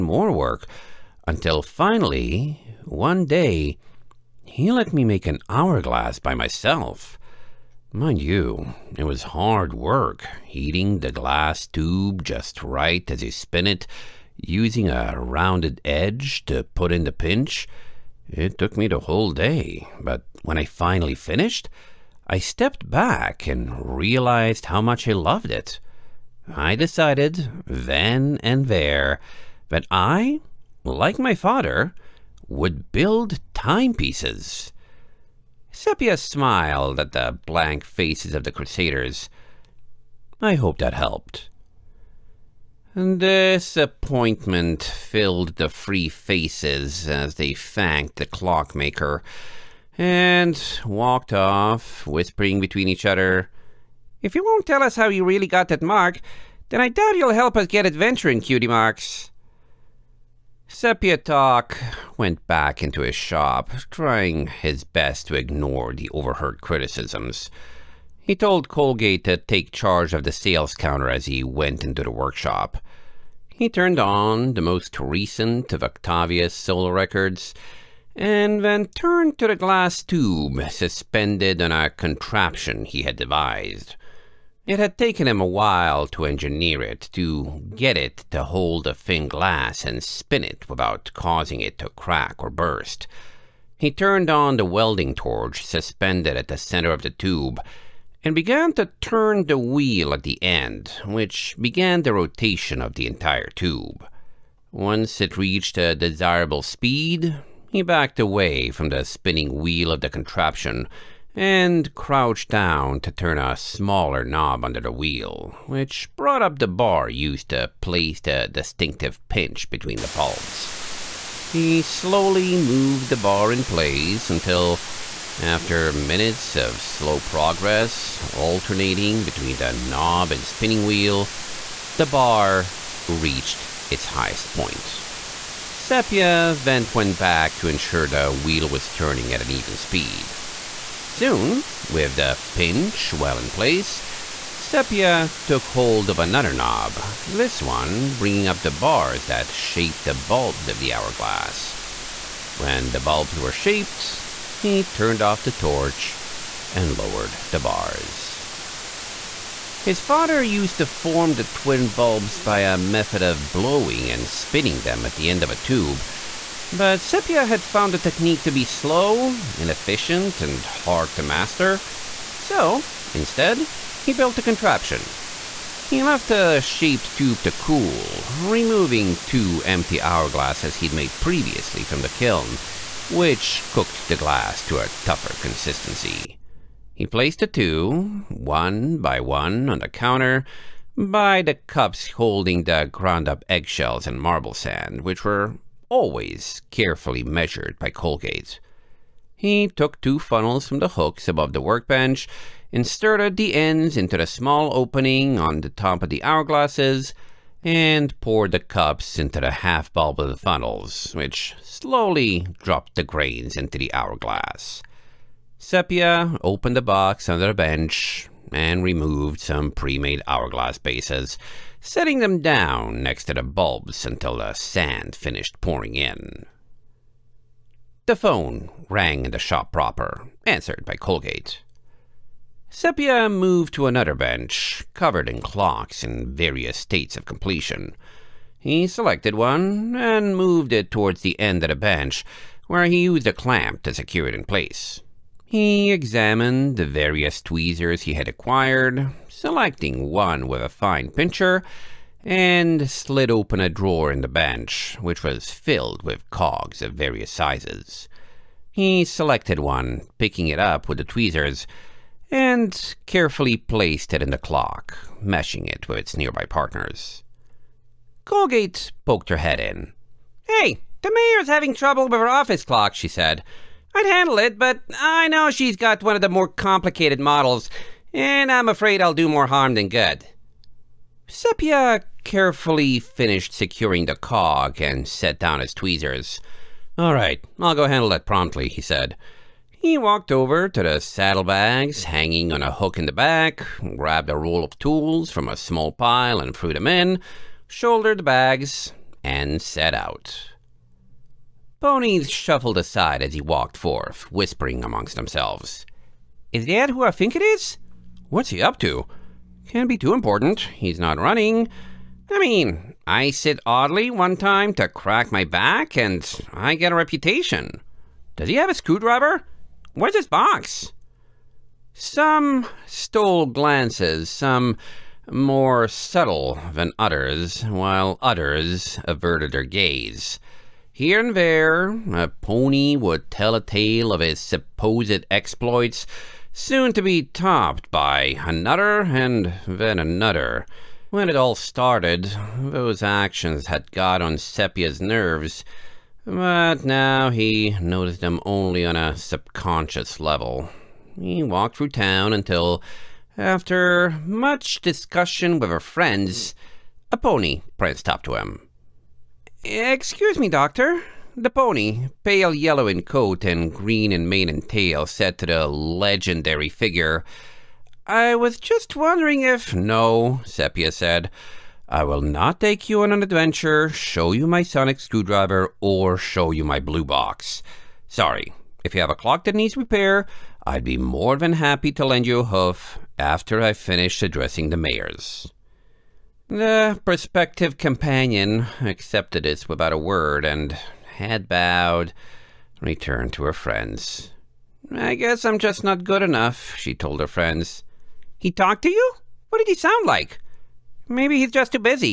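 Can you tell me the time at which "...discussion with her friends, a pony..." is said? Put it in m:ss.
5:54.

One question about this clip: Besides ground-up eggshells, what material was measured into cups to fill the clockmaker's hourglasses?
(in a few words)
marble sand.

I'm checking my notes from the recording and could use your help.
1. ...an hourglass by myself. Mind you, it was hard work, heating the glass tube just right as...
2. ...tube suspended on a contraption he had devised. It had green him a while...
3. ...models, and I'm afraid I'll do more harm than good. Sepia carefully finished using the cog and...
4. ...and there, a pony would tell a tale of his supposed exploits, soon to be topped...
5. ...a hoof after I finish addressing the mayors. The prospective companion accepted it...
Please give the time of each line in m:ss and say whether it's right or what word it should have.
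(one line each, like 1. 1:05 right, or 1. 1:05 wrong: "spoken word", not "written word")
1. 0:05 right
2. 1:20 wrong: "taken", not "green"
3. 4:37 wrong: "securing", not "using"
4. 5:31 right
5. 6:22 right.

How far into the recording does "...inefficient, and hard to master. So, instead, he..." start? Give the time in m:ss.
2:49.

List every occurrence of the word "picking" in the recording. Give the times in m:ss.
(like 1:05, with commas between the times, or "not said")
4:20.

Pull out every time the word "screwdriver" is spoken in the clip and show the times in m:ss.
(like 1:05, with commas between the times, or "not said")
5:18, 6:14.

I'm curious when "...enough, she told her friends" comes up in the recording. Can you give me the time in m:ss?
6:36.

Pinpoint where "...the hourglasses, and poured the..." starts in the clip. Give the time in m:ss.
3:26.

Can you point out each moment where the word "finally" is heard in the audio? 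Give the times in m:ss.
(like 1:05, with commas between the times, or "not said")
0:01, 0:20.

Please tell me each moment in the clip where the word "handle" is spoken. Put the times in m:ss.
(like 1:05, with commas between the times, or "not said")
4:34, 4:47.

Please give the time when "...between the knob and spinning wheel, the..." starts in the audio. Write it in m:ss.
2:09.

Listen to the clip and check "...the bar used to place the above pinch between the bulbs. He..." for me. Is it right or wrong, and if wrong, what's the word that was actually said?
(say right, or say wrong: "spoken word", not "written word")
wrong: "distinctive", not "above".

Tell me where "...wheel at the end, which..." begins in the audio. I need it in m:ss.
1:39.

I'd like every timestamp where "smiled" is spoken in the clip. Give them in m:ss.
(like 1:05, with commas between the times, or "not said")
0:36.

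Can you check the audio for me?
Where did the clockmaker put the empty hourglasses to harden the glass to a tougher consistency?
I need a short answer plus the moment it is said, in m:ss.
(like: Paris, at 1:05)
the kiln, at 3:02.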